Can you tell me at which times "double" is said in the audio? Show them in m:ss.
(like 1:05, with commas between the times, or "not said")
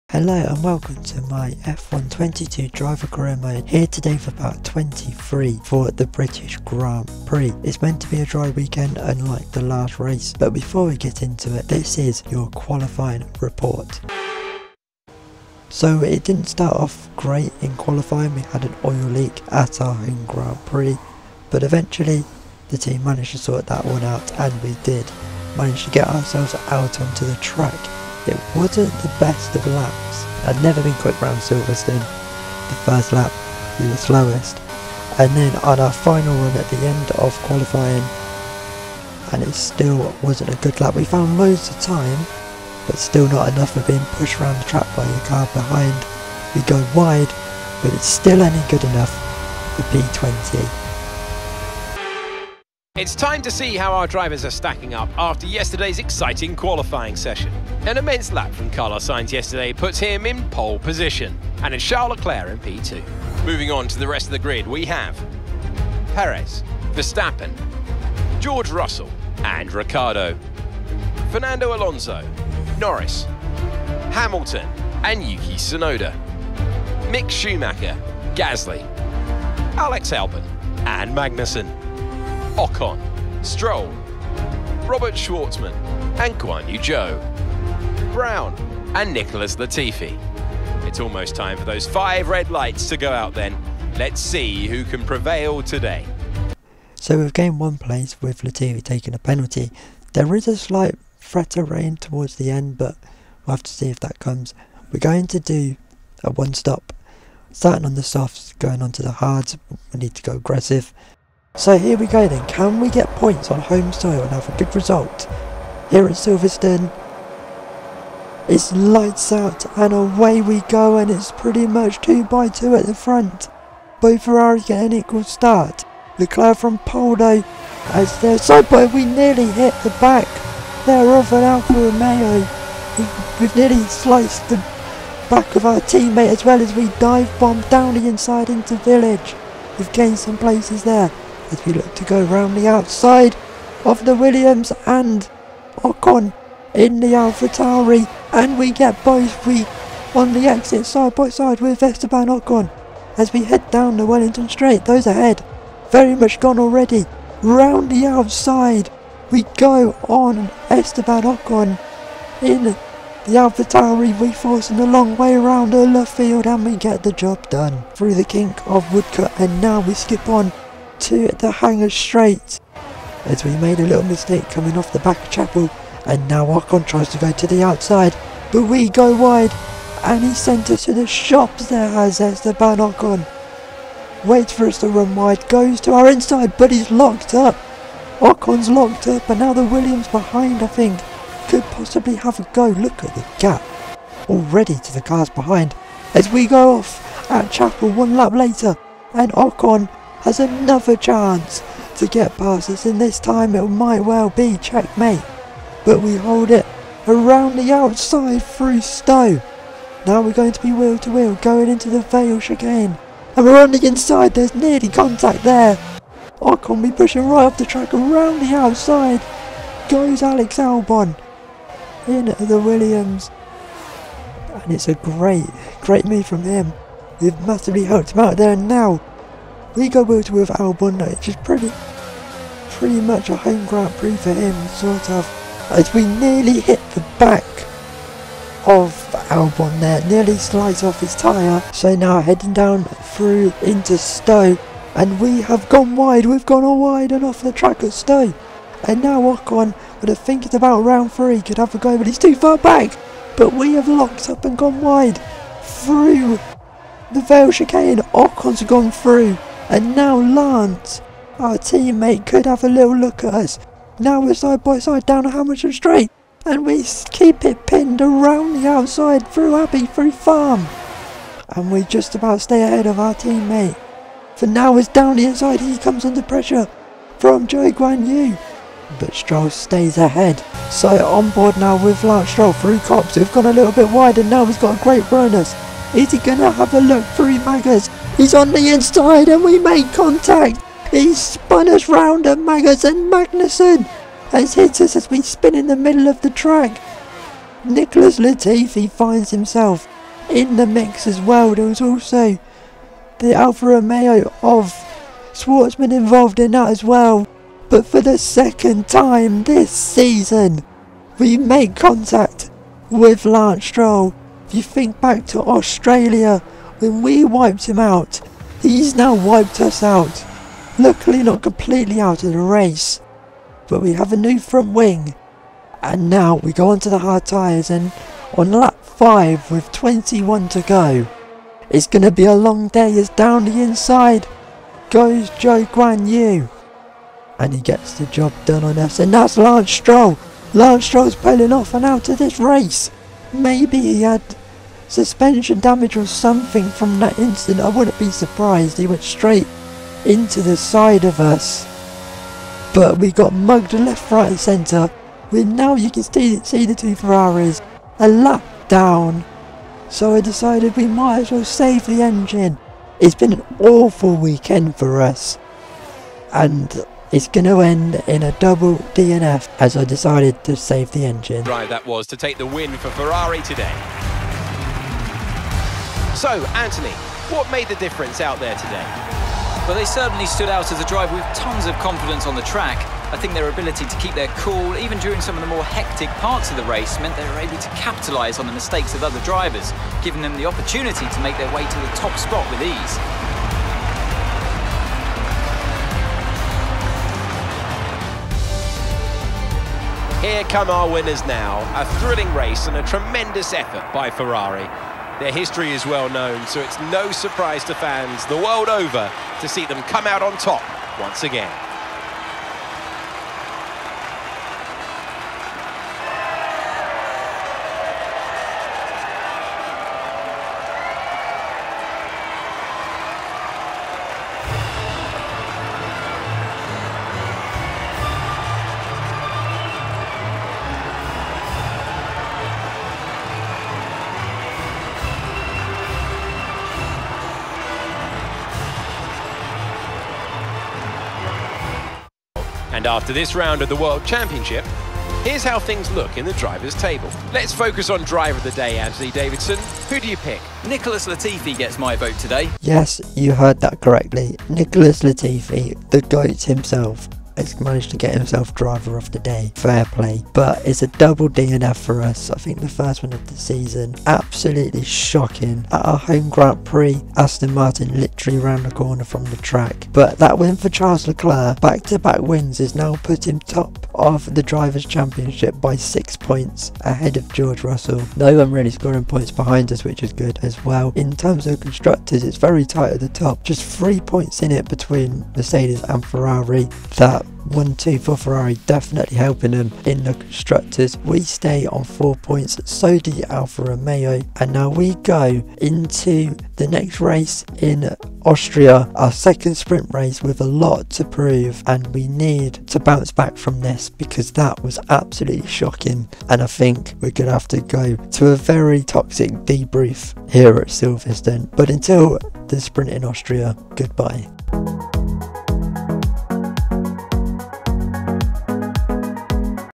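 6:08, 7:40.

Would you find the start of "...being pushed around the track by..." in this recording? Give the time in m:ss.
0:43.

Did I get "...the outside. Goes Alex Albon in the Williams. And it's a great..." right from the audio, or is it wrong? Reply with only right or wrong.
right.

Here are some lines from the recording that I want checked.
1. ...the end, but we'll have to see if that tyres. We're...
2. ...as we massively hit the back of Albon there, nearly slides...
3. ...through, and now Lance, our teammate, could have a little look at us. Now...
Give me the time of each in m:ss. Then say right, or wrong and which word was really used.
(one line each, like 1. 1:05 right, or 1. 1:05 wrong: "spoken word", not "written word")
1. 1:42 wrong: "comes", not "tyres"
2. 3:55 wrong: "nearly", not "massively"
3. 4:18 right.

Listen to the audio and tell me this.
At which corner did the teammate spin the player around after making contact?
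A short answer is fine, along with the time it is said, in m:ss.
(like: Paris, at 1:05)
Maggotts, at 4:52.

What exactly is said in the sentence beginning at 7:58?
No one really scoring points behind us, which is good as well.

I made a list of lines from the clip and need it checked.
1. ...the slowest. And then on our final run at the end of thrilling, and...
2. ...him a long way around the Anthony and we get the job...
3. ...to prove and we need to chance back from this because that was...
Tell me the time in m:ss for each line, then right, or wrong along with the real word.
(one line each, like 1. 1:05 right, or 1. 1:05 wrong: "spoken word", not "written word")
1. 0:33 wrong: "qualifying", not "thrilling"
2. 2:44 wrong: "Luffield", not "Anthony"
3. 8:20 wrong: "bounce", not "chance".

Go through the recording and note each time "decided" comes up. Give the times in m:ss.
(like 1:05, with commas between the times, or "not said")
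6:00, 6:09.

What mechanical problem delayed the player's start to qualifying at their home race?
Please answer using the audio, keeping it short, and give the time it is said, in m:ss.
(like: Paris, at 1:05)
Oil leak, at 0:18.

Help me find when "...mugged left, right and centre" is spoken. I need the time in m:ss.
5:53.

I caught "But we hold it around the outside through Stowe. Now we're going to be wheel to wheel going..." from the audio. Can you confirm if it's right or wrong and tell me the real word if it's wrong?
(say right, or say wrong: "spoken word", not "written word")
right.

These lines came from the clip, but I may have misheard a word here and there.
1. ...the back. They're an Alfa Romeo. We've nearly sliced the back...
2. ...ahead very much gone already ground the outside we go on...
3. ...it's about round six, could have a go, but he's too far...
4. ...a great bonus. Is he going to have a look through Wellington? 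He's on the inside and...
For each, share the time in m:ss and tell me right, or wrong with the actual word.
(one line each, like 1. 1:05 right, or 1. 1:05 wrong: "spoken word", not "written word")
1. 2:09 right
2. 2:35 wrong: "round", not "ground"
3. 4:10 wrong: "three", not "six"
4. 4:44 wrong: "Maggers", not "Wellington".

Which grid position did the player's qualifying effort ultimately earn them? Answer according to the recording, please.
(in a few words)
P20.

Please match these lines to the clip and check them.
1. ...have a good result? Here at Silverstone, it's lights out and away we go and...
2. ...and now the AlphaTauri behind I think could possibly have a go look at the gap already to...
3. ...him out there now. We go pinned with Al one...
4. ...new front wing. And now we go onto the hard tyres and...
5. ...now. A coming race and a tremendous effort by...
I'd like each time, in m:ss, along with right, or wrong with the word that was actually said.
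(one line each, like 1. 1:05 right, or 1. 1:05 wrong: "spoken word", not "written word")
1. 1:54 right
2. 3:09 wrong: "Williams", not "AlphaTauri"
3. 3:48 wrong: "worked", not "pinned"
4. 5:24 right
5. 6:41 wrong: "thrilling", not "coming".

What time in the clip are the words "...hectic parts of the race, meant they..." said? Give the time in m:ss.
6:25.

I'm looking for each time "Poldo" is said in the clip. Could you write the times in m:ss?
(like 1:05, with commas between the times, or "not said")
2:06.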